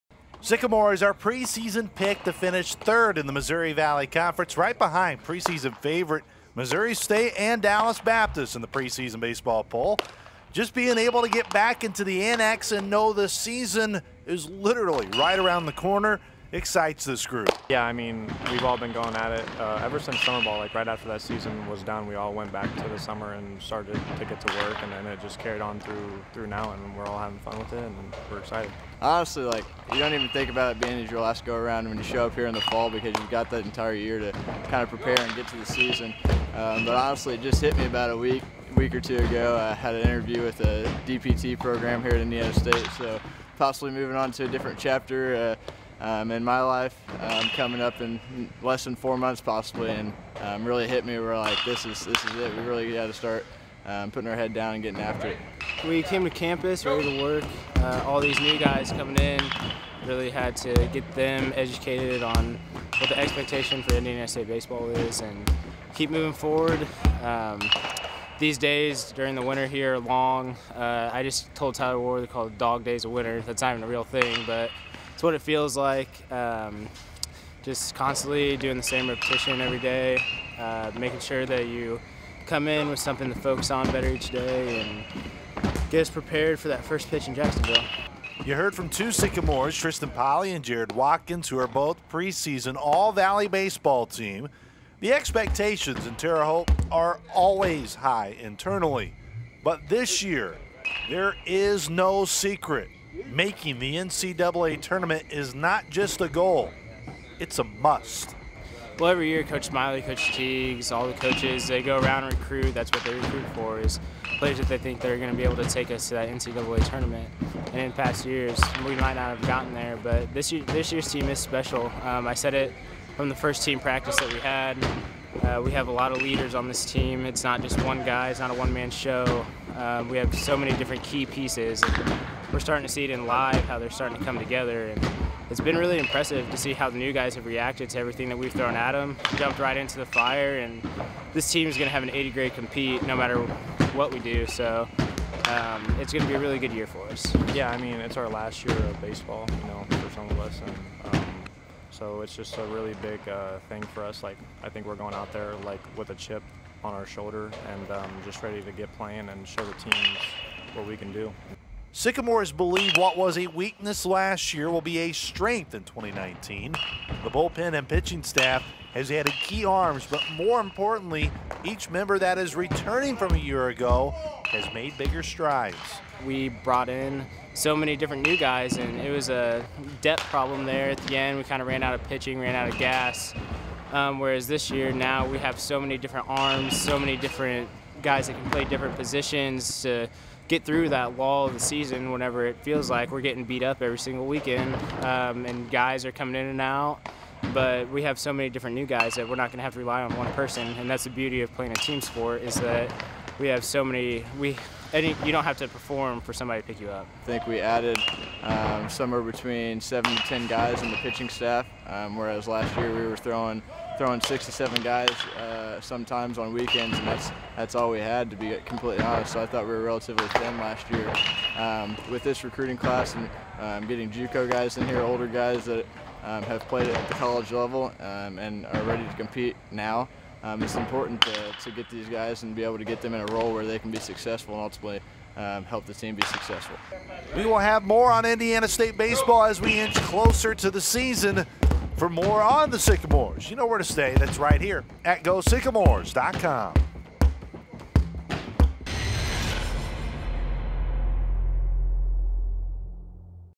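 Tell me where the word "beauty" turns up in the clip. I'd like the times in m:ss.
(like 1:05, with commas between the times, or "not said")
3:21.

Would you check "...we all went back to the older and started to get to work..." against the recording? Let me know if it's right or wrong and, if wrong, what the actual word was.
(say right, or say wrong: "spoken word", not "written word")
wrong: "summer", not "older".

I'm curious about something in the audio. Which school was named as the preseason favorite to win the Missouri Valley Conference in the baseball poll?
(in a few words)
Missouri State.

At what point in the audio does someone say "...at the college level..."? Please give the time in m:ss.
3:46.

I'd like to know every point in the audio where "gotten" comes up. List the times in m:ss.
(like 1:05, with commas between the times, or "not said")
1:59.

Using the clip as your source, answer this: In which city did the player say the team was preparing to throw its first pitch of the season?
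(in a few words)
Jacksonville.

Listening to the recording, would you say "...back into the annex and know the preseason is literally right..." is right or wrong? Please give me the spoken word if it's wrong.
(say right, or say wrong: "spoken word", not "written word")
wrong: "season", not "preseason".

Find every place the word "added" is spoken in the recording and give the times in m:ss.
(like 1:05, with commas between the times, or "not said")
2:49, 3:27.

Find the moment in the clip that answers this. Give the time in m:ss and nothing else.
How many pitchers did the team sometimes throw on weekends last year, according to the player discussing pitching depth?
3:34.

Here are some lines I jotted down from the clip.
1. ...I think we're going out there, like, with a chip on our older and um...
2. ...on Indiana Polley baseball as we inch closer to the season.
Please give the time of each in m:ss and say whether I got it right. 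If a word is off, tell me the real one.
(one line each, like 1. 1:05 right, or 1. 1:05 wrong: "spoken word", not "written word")
1. 2:34 wrong: "shoulder", not "older"
2. 3:58 wrong: "State", not "Polley".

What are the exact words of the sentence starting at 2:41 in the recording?
Sycamores believe what was a weakness last year will be a strength in 2019.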